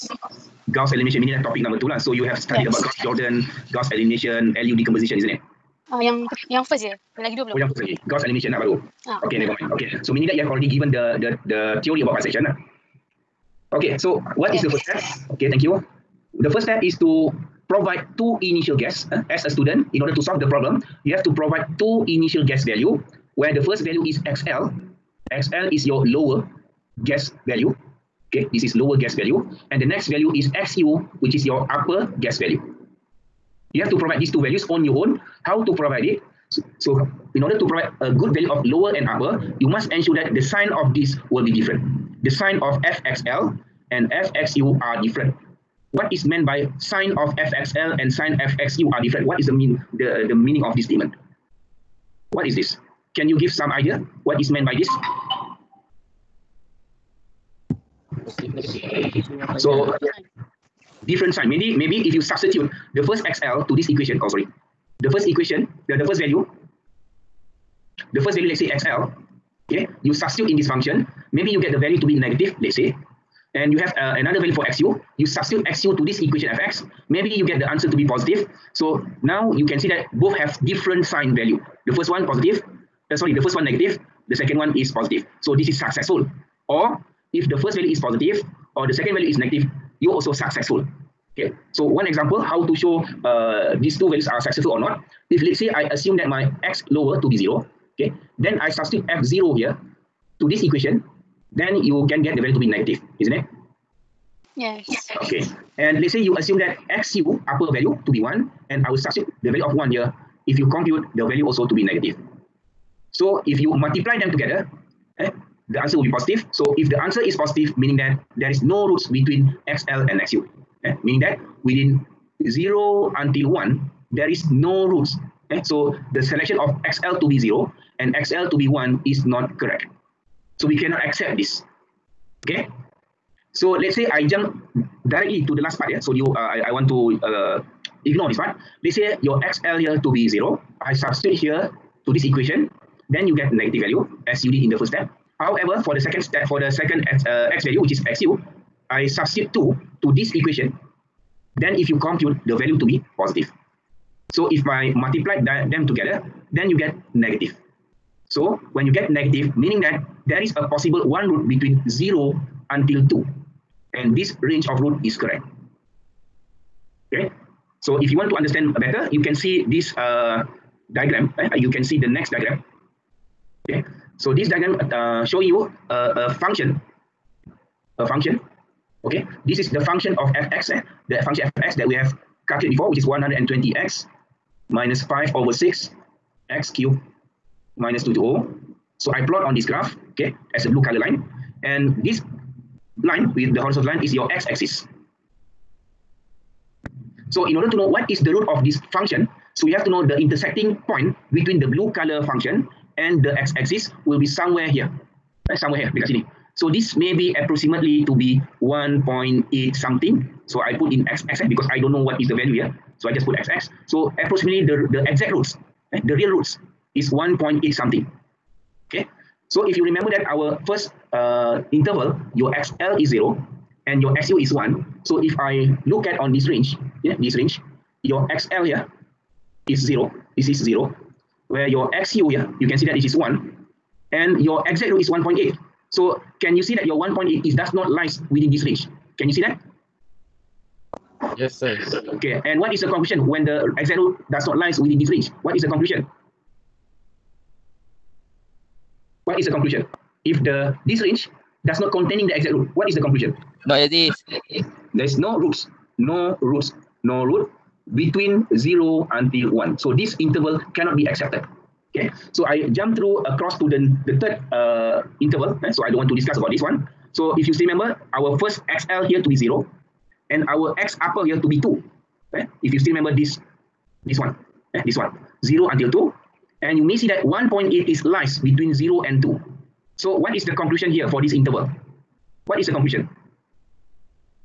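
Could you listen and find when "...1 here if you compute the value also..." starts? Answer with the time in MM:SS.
01:49.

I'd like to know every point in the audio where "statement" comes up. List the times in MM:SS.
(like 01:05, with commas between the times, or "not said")
00:50.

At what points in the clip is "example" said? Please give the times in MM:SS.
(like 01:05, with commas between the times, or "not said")
01:32.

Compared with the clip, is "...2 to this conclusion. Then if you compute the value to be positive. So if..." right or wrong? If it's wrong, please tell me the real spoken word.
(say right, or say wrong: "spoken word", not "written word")
wrong: "equation", not "conclusion".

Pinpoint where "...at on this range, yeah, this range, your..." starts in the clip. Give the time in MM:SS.
03:46.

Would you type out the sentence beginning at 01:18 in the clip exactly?
So now you can see that both have different sign value.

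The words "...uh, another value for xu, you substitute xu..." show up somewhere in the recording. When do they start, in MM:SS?
01:13.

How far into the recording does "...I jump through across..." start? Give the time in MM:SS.
04:22.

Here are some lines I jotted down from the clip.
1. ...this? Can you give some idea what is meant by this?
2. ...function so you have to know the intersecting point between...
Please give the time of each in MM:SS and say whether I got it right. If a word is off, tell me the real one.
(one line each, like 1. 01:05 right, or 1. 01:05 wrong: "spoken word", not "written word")
1. 00:52 right
2. 03:18 right.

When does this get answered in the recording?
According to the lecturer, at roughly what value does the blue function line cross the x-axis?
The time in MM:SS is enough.
03:27.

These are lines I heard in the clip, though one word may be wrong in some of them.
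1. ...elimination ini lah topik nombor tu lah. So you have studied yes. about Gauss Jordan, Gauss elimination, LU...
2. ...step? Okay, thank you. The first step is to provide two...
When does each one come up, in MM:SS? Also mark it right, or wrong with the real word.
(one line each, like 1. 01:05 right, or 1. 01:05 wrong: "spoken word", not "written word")
1. 00:00 right
2. 00:14 right.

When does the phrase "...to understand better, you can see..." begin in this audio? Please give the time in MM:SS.
02:48.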